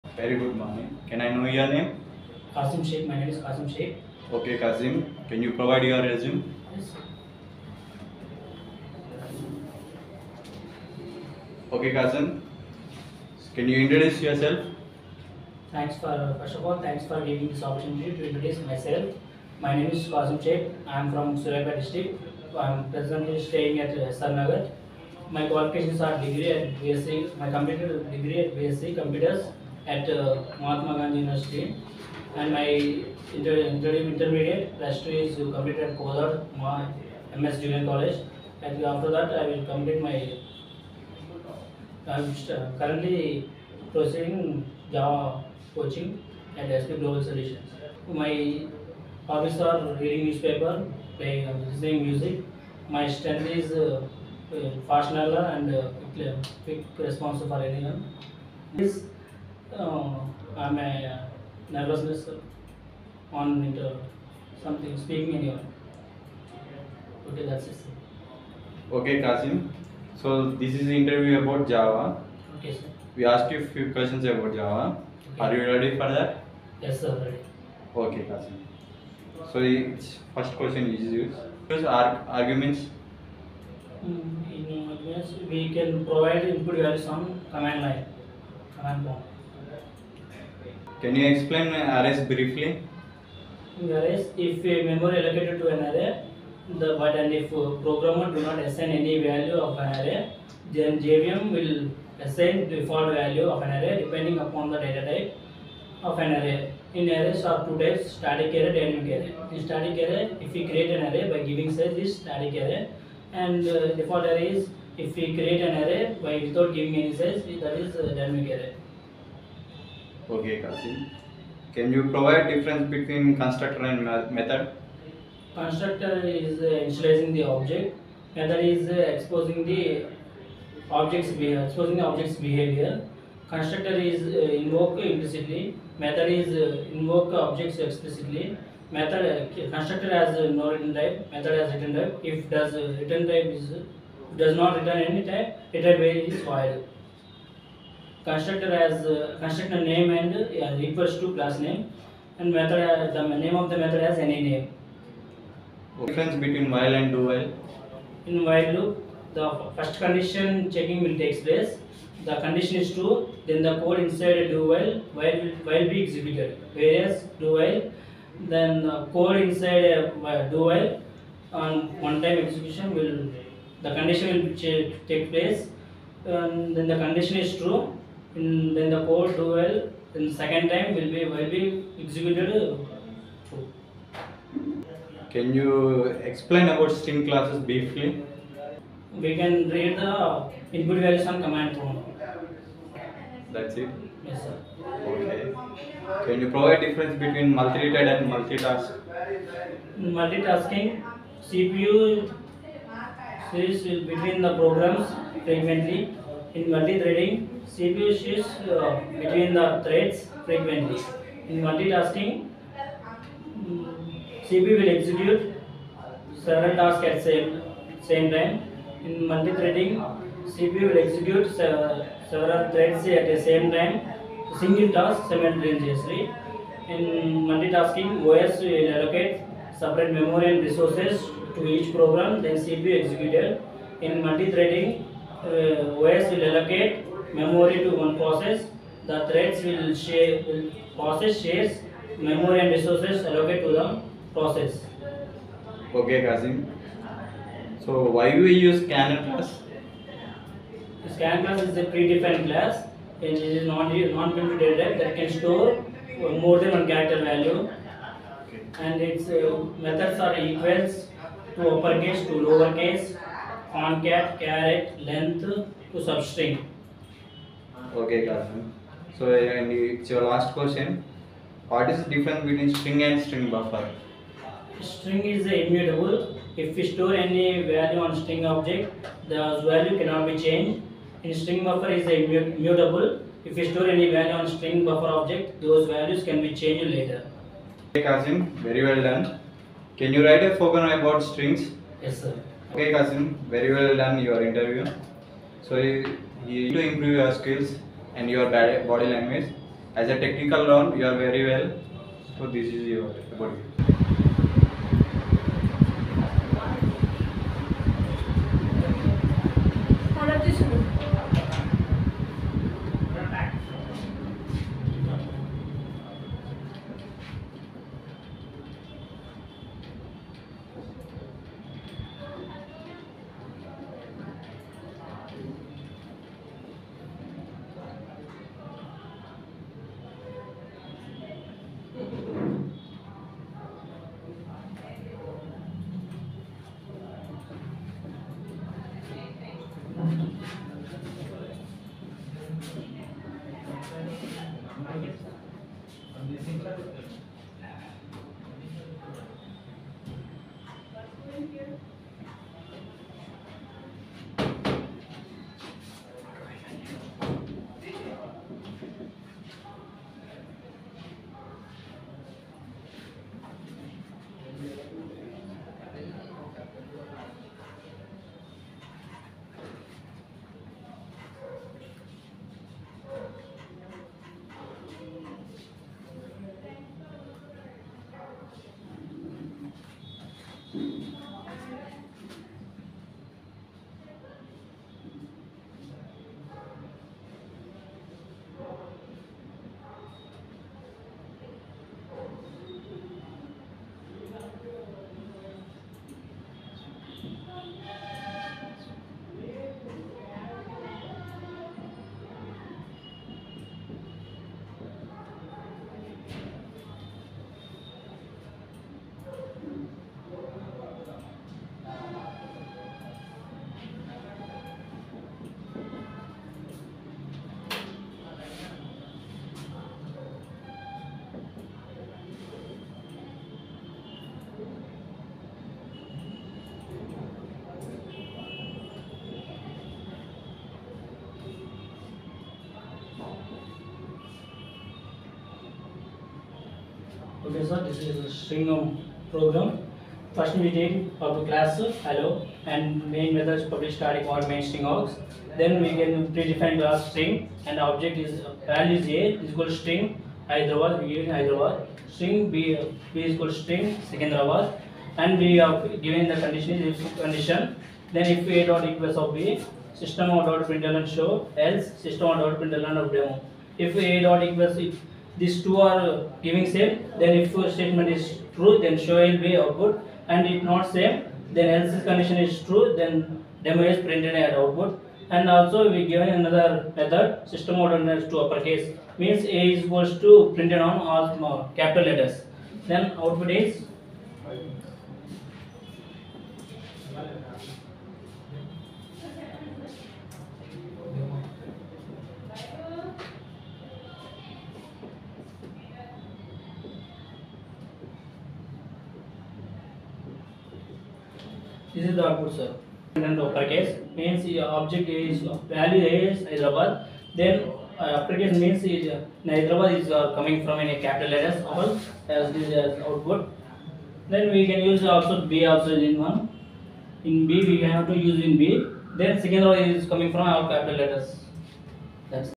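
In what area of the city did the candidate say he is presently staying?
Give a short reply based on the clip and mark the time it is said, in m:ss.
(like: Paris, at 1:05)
SR Nagar, at 0:24.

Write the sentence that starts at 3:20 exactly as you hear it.
Multitasking, CPU switch between the programs frequently.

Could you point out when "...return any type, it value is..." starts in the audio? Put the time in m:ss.
2:24.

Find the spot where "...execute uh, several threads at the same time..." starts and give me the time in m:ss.
3:41.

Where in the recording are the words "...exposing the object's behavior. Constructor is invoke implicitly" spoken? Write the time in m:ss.
2:11.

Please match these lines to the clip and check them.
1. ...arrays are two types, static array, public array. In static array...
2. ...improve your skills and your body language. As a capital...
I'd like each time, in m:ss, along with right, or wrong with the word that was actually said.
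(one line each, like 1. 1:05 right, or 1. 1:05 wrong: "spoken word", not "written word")
1. 1:47 wrong: "dynamic", not "public"
2. 4:56 wrong: "technical", not "capital".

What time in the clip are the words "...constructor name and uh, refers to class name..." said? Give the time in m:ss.
2:29.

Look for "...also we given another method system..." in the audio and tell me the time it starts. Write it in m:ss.
7:55.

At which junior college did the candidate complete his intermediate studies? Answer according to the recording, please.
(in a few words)
Kozad MS Junior College.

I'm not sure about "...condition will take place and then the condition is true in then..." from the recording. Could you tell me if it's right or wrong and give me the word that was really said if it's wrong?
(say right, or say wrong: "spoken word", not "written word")
right.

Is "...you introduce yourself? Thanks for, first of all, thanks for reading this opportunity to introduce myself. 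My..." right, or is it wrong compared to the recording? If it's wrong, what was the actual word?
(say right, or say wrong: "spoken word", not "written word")
wrong: "giving", not "reading".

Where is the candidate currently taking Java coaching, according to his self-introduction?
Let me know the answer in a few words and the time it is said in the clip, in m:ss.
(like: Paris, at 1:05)
SP Global Solutions, at 0:46.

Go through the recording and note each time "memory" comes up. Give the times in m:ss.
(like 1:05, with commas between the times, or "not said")
1:34, 3:50, 3:57, 4:02.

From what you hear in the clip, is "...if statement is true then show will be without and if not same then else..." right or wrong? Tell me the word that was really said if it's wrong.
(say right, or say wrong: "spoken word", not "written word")
wrong: "output", not "without".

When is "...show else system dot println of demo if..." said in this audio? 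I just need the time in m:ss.
7:41.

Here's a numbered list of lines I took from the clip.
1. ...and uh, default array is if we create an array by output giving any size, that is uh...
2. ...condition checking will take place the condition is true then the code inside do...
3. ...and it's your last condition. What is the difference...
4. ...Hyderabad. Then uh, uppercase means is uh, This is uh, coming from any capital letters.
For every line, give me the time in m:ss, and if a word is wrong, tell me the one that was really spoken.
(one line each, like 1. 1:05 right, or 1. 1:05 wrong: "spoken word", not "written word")
1. 1:53 wrong: "without", not "output"
2. 2:40 right
3. 4:29 wrong: "question", not "condition"
4. 8:26 wrong: "Hyderabad", not "This".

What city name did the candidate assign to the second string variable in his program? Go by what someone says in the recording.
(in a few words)
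Secunderabad.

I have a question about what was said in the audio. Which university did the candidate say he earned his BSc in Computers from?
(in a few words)
Mahatma Gandhi University.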